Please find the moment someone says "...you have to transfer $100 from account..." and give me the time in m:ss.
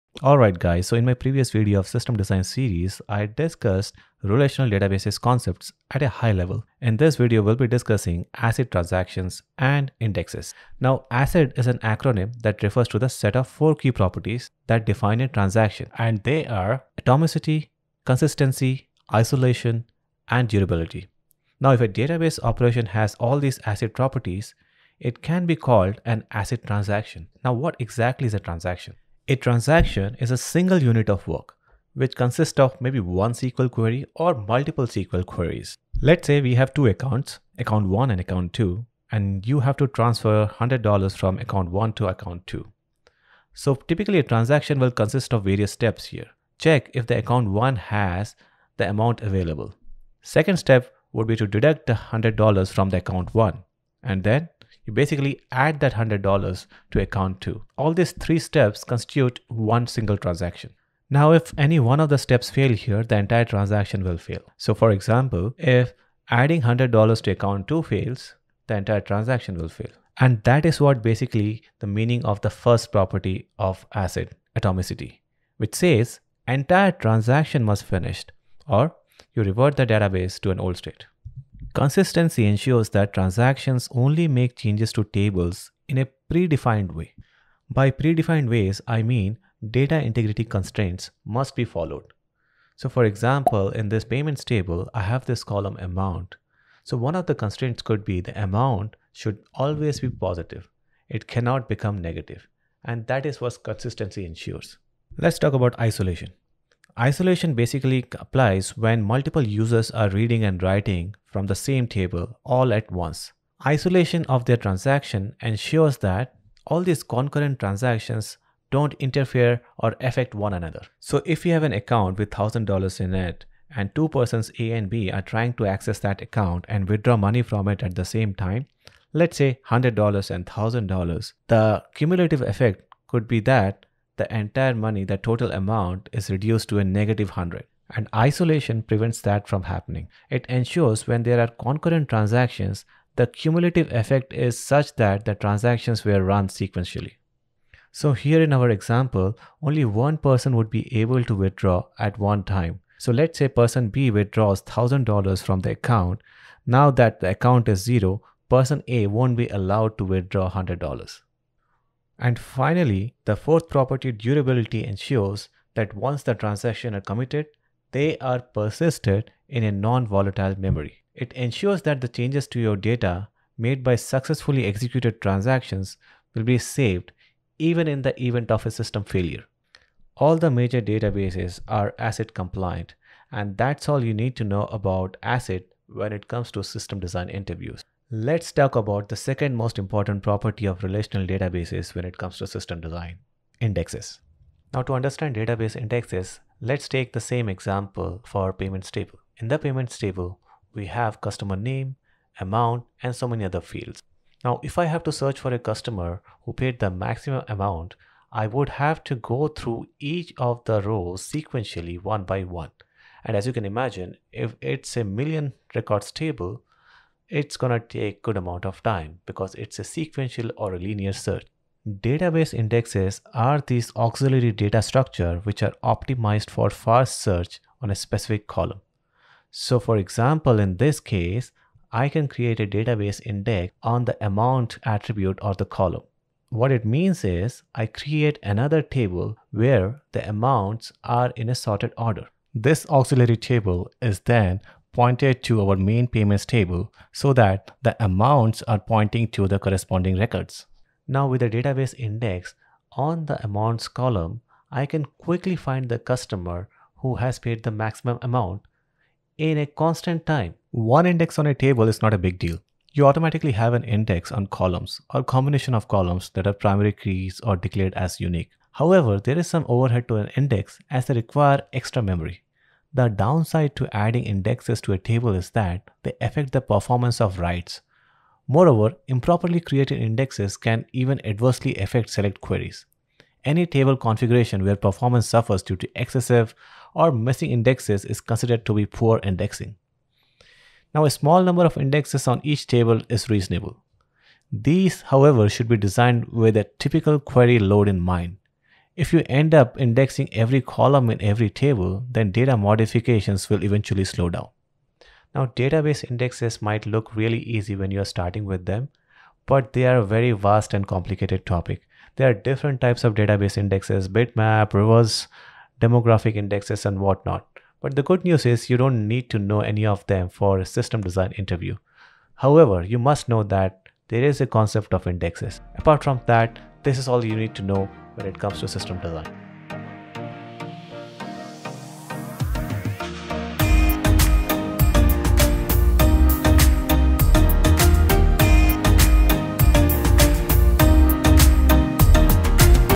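0:39.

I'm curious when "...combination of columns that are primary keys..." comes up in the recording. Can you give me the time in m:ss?
4:25.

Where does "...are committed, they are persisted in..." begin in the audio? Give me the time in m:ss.
2:46.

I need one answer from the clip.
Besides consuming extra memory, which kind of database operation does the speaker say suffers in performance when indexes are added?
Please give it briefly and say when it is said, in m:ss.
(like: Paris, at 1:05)
Writes, at 4:37.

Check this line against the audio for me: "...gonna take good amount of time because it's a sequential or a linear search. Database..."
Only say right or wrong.
right.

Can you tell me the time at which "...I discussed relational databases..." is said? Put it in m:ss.
0:03.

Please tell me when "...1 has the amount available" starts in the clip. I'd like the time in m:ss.
0:47.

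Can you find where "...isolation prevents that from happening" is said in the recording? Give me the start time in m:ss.
2:18.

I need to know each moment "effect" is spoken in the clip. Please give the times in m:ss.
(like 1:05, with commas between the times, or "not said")
2:12, 2:23.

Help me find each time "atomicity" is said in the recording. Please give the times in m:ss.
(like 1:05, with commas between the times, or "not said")
0:17, 1:14.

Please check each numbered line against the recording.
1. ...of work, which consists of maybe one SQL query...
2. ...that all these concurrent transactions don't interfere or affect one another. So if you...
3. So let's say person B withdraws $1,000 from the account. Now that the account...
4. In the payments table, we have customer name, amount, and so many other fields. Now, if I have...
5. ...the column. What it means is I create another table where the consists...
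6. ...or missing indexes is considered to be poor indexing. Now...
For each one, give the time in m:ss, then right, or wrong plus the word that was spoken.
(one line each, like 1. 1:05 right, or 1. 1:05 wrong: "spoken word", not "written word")
1. 0:31 right
2. 1:55 right
3. 2:32 right
4. 3:19 right
5. 3:55 wrong: "amounts", not "consists"
6. 4:46 right.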